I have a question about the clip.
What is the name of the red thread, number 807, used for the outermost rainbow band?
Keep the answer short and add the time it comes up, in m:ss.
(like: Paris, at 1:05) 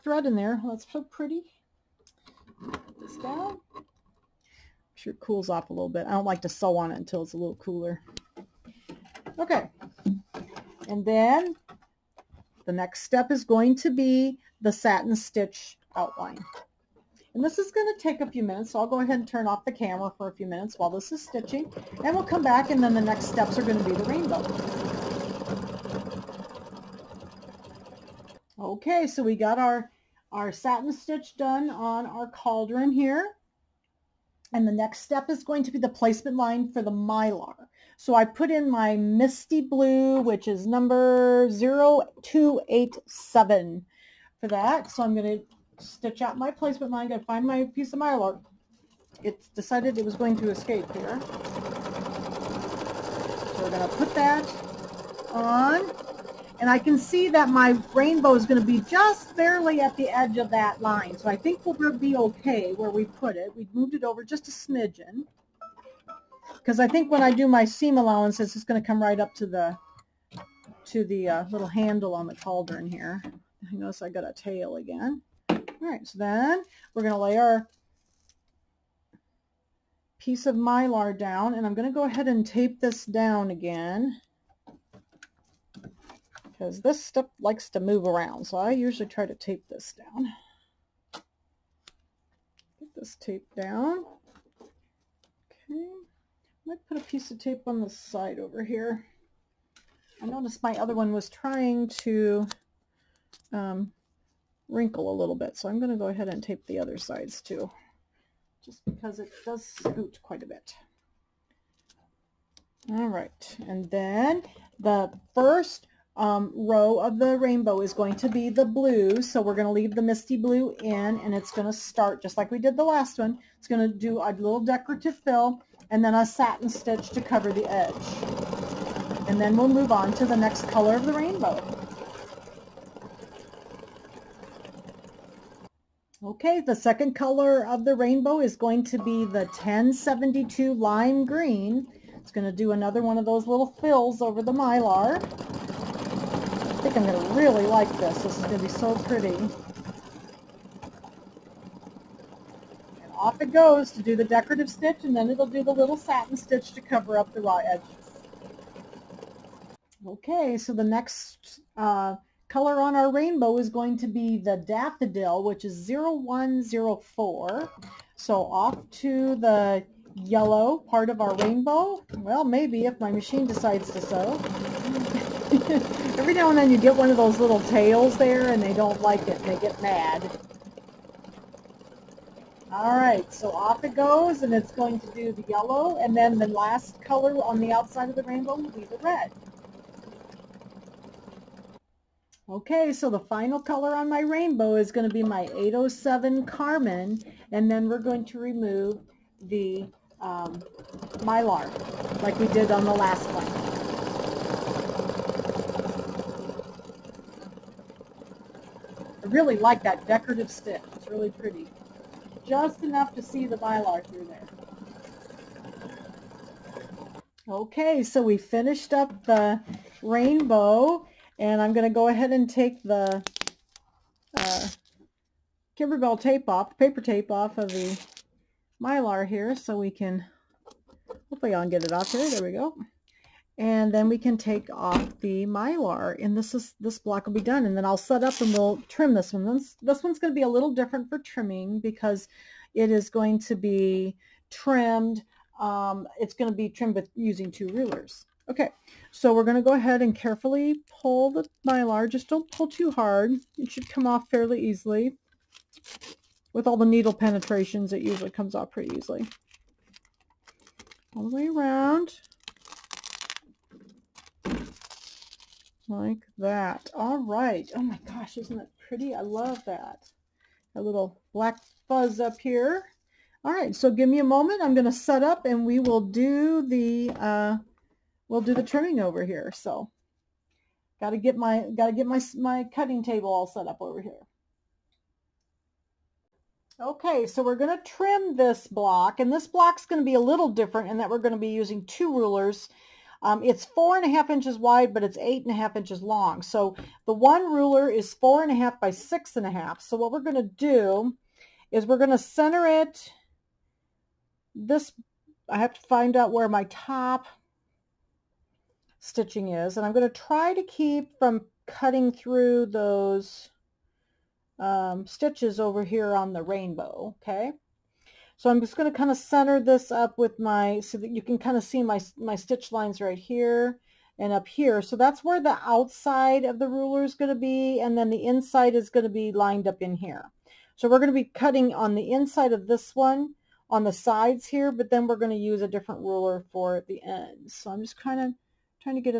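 Carmine, at 3:16.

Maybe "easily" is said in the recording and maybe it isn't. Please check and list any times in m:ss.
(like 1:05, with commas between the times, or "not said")
4:14, 4:18.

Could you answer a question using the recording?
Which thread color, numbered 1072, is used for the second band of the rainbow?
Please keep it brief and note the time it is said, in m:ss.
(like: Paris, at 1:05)
lime green, at 2:20.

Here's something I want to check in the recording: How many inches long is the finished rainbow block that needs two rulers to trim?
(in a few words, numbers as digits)
8.5 inches.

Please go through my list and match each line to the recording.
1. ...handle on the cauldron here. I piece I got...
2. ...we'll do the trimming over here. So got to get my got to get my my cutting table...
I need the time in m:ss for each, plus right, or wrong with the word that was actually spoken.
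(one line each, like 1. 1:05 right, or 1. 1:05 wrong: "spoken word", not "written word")
1. 1:11 wrong: "notice", not "piece"
2. 4:38 right.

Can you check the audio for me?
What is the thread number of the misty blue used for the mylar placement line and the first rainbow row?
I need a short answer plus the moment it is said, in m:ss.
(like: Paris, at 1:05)
0287, at 0:41.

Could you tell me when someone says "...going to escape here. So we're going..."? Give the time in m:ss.
0:50.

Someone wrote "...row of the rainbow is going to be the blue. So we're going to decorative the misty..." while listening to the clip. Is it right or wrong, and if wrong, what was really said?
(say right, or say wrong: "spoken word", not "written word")
wrong: "leave", not "decorative".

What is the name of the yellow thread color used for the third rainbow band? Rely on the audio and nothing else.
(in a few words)
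daffodil.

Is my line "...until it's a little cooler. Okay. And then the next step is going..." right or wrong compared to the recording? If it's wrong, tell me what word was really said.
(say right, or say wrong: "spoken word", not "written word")
right.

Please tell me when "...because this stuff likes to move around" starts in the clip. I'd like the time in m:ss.
1:26.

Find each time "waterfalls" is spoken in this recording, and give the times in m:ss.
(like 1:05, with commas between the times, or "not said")
not said.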